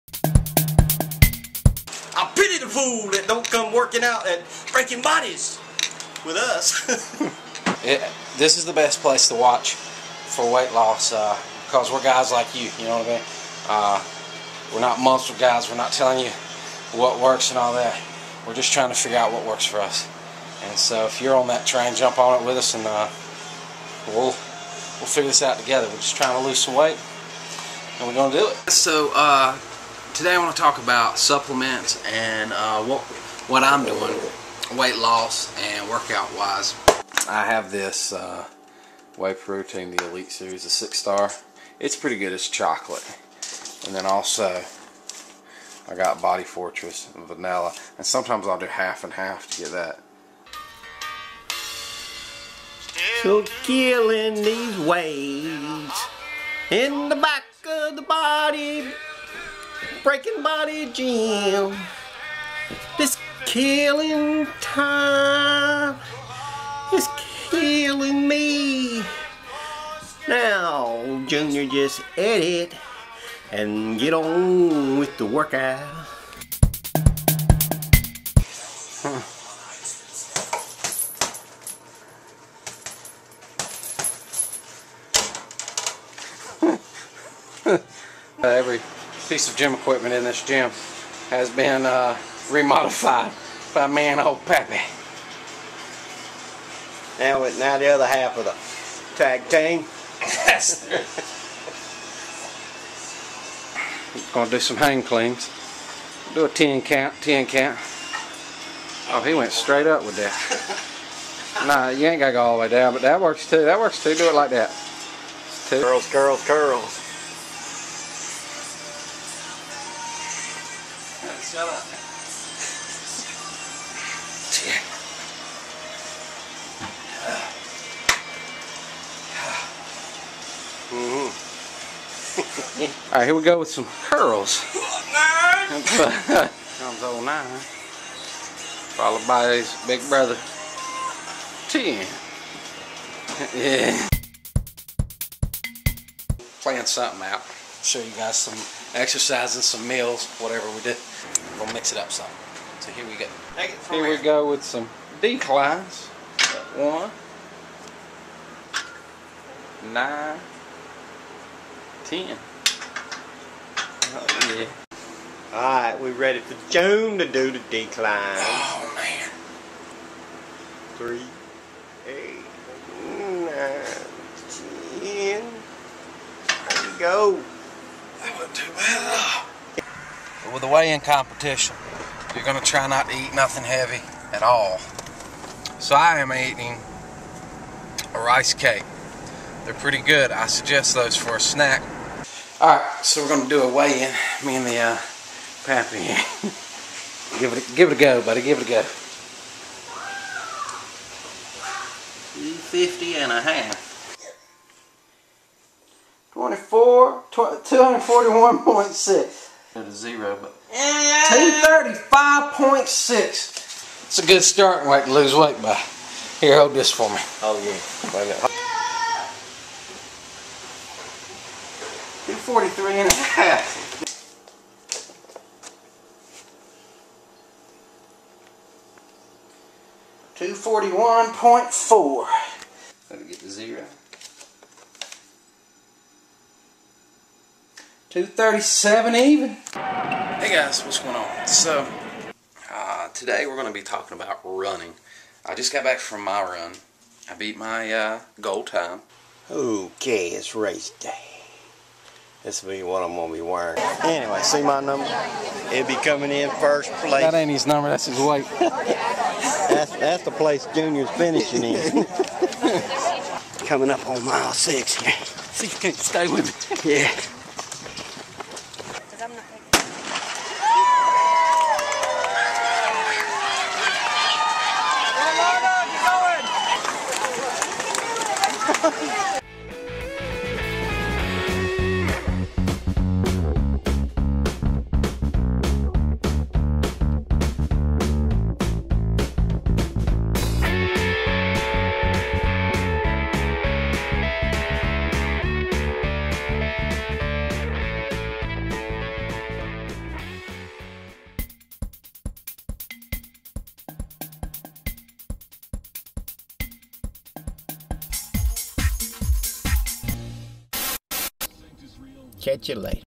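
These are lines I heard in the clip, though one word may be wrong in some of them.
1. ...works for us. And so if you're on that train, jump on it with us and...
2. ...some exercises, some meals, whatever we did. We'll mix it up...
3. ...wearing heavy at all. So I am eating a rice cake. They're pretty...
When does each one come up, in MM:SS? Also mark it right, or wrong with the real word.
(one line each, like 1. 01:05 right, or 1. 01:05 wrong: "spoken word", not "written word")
1. 00:19 right
2. 02:28 right
3. 03:03 wrong: "nothing", not "wearing".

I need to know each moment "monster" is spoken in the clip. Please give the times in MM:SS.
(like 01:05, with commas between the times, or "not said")
00:14.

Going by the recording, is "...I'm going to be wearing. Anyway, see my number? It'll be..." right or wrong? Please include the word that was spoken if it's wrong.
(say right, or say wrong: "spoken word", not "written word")
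right.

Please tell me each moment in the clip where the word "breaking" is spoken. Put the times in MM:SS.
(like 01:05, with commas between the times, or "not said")
00:04, 01:00.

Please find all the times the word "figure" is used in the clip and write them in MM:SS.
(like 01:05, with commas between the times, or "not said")
00:18, 00:25.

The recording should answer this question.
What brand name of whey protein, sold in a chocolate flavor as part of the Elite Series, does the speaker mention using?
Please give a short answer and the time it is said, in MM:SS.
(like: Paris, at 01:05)
Six Star, at 00:40.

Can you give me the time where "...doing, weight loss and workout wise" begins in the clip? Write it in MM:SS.
00:33.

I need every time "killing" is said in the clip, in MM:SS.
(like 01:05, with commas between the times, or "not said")
00:53, 01:03, 01:07.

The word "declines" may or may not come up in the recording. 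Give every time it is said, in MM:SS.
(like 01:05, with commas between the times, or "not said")
02:35, 02:47.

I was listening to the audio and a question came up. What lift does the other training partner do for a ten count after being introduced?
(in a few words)
hang cleans.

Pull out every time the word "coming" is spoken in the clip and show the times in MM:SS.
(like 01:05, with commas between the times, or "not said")
04:16, 04:23.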